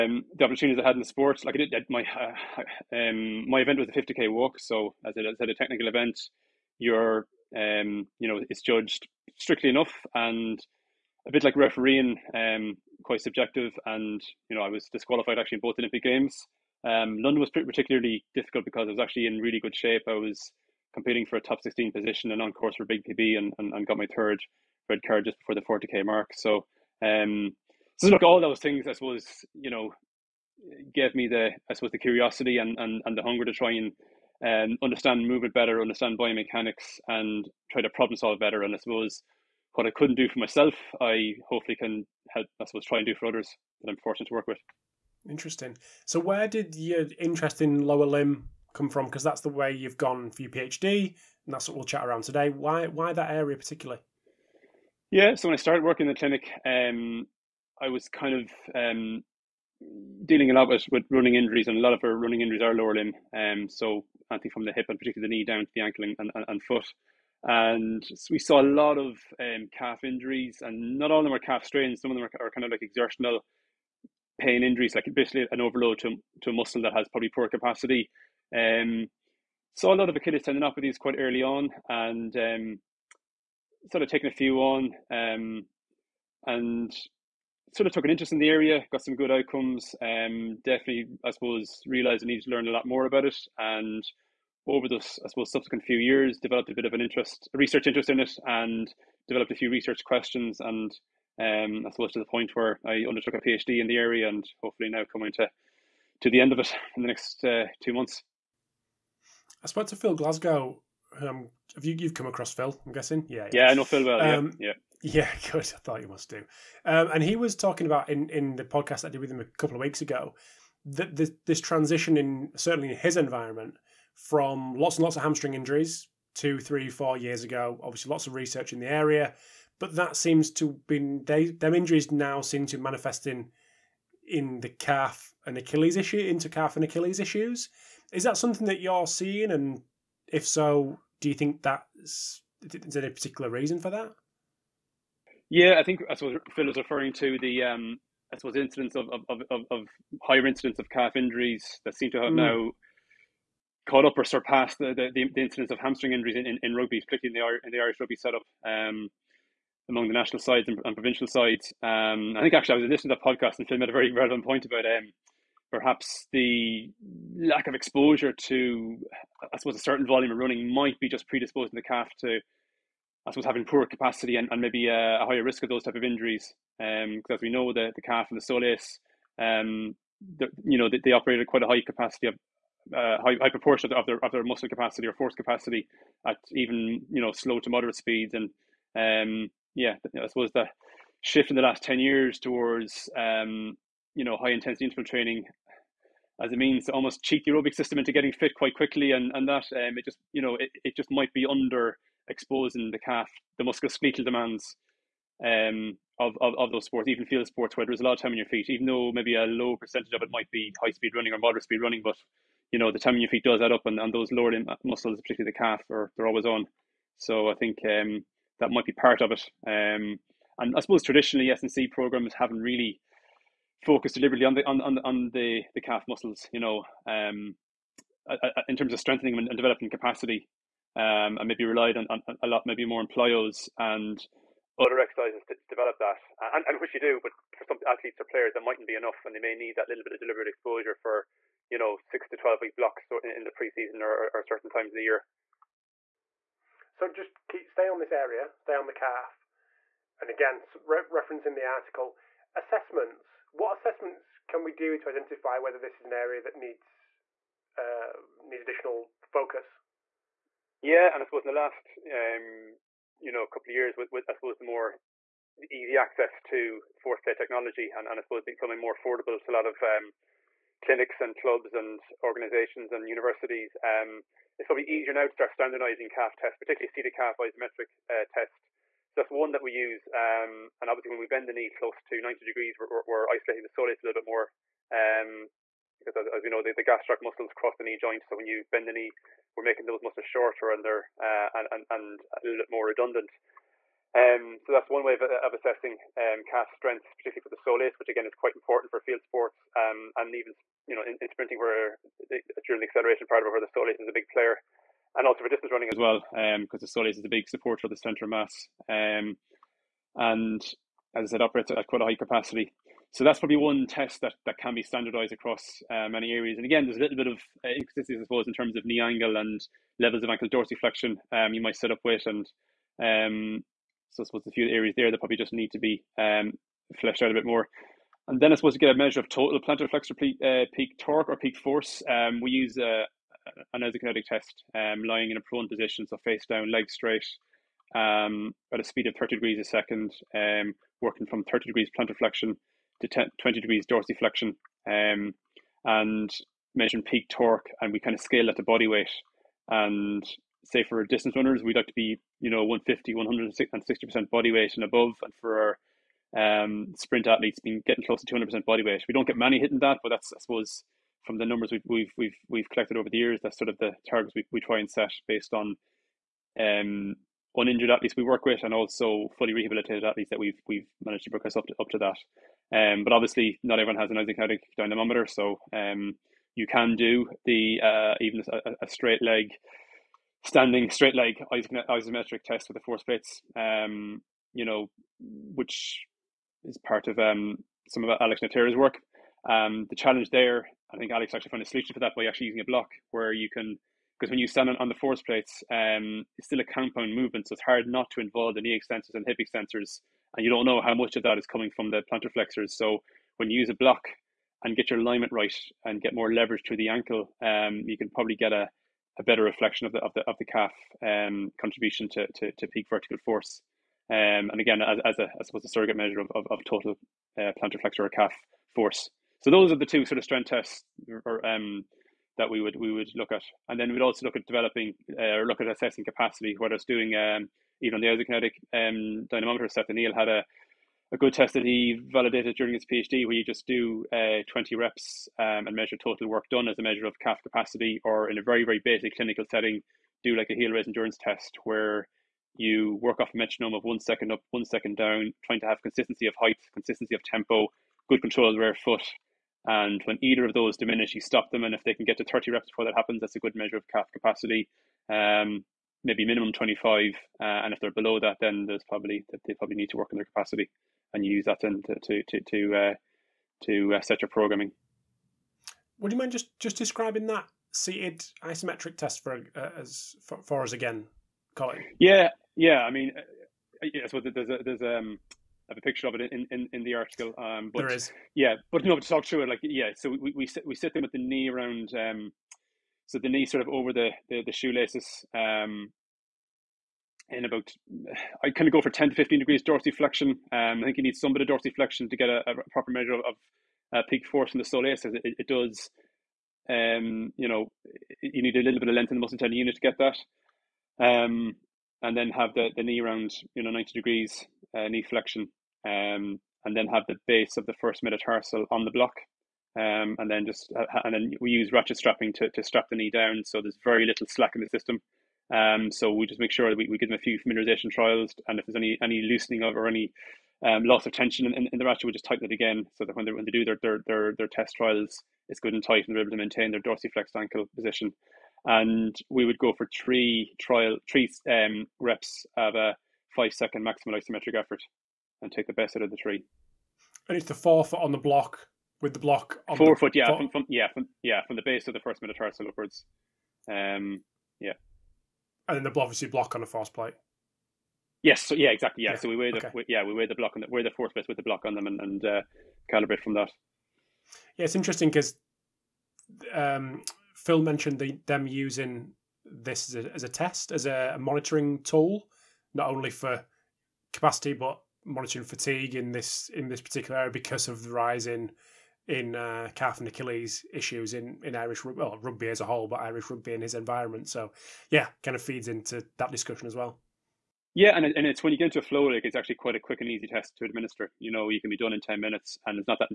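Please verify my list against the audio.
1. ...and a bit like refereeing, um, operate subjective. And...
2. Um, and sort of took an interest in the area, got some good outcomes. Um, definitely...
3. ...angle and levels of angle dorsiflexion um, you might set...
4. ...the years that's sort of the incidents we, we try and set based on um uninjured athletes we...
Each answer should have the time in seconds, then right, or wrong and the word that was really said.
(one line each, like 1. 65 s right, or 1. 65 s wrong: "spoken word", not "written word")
1. 10 s wrong: "quite", not "operate"
2. 85 s right
3. 318 s wrong: "ankle", not "angle"
4. 363 s wrong: "targets", not "incidents".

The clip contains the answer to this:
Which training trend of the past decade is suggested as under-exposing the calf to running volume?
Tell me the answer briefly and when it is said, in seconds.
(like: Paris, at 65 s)
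High intensity interval training, at 194 s.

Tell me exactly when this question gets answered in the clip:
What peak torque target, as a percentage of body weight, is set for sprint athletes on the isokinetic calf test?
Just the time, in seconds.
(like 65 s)
358 s.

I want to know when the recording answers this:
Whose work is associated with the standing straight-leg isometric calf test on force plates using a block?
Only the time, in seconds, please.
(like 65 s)
388 s.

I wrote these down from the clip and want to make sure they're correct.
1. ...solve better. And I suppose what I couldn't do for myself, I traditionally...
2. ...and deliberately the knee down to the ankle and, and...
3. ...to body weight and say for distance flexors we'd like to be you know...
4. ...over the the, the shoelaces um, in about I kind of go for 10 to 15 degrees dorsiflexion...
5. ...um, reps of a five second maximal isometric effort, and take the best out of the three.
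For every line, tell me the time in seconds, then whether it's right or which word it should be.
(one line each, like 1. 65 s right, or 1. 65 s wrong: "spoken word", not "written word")
1. 38 s wrong: "hopefully", not "traditionally"
2. 64 s wrong: "particularly", not "deliberately"
3. 348 s wrong: "runners", not "flexors"
4. 483 s right
5. 531 s right.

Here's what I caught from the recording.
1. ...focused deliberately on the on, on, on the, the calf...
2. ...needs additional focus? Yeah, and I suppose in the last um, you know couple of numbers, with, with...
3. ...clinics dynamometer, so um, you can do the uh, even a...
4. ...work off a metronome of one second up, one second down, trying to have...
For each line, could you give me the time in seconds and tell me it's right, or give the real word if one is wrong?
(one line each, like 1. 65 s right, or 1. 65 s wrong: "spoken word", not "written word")
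1. 223 s right
2. 258 s wrong: "years", not "numbers"
3. 374 s wrong: "isokinetics", not "clinics"
4. 443 s right.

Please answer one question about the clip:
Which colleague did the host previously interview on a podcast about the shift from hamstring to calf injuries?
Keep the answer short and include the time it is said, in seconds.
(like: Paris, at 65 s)
Phil Glasgow, at 109 s.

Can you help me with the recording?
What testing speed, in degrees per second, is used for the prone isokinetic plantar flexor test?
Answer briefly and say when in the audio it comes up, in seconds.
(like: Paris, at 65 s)
30 degrees a second, at 339 s.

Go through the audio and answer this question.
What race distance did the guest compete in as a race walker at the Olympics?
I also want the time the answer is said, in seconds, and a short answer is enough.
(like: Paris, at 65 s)
50k walk, at 3 s.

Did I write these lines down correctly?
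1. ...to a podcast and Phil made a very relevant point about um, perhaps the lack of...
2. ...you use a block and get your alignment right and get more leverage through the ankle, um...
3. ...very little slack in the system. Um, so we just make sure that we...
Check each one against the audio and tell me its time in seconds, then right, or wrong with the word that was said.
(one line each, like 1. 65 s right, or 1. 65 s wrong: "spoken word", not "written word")
1. 163 s right
2. 403 s right
3. 513 s right.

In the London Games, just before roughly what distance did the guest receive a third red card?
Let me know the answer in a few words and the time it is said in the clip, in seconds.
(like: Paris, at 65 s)
40k, at 25 s.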